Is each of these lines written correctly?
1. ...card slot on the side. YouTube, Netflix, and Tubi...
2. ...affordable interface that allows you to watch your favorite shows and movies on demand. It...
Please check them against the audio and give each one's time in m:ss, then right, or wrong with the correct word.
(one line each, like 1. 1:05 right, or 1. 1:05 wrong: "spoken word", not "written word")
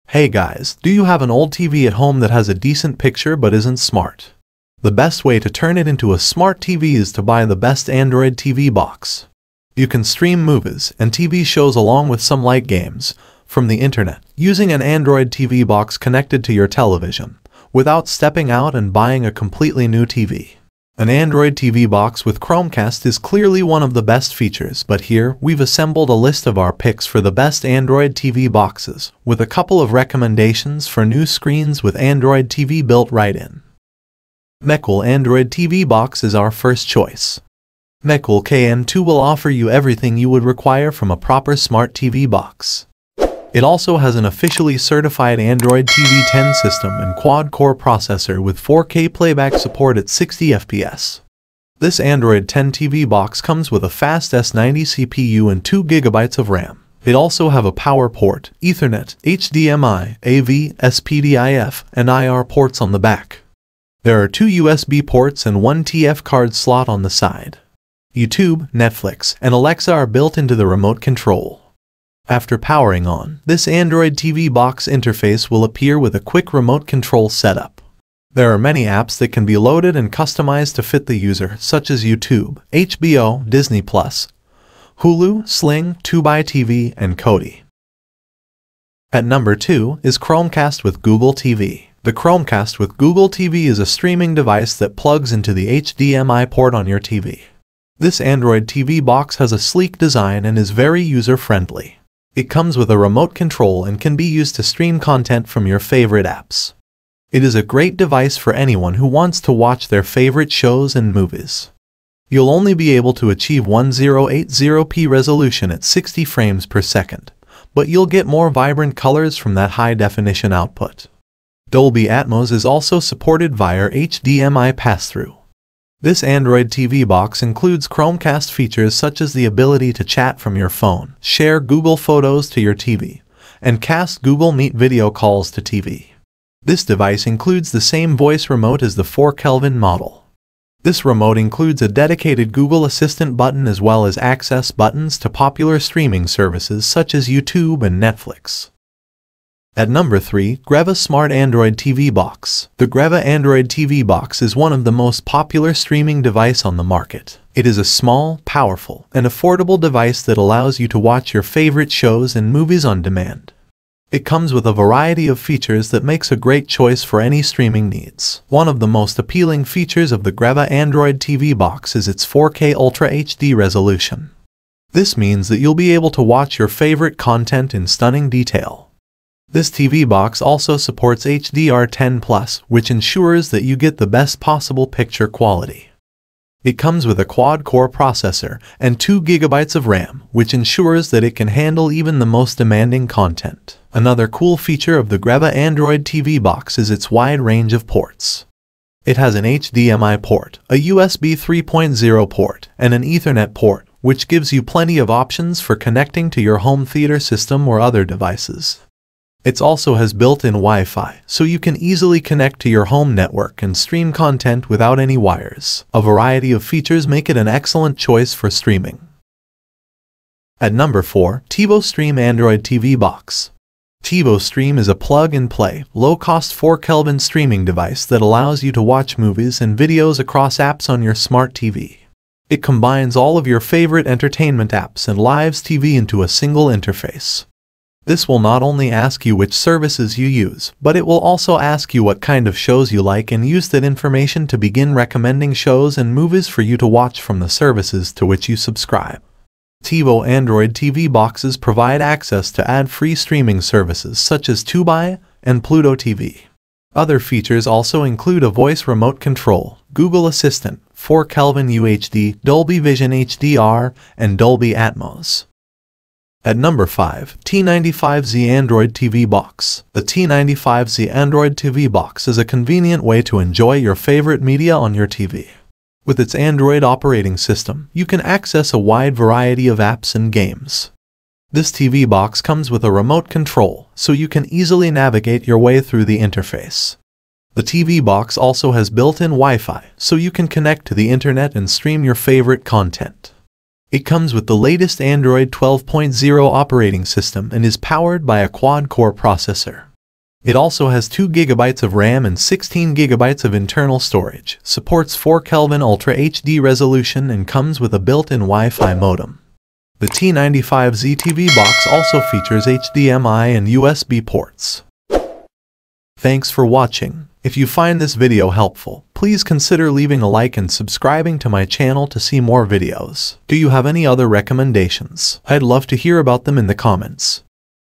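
1. 1:06 wrong: "Alexa", not "Tubi"
2. 2:39 wrong: "device", not "interface".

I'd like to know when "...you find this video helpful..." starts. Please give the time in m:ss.
5:17.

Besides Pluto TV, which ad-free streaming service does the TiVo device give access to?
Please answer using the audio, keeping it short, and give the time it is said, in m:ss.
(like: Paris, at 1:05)
Tubi, at 4:14.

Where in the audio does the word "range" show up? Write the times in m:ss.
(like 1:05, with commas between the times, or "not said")
3:17.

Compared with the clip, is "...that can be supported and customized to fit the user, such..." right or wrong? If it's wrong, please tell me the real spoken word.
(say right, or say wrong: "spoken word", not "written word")
wrong: "loaded", not "supported".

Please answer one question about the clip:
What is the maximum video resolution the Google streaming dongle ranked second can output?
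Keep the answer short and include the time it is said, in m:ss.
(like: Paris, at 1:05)
1080p, at 1:53.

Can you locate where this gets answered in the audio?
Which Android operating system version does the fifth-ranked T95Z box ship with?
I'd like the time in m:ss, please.
4:55.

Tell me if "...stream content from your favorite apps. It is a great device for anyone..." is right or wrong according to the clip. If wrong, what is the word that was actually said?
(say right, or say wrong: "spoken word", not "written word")
right.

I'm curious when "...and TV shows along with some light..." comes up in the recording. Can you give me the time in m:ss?
0:10.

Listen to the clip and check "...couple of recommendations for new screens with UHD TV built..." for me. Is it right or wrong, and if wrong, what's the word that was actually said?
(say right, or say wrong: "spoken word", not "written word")
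wrong: "Android", not "UHD".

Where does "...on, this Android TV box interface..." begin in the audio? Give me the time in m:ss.
1:13.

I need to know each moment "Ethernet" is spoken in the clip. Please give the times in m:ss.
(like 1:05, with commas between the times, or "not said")
0:58, 3:23.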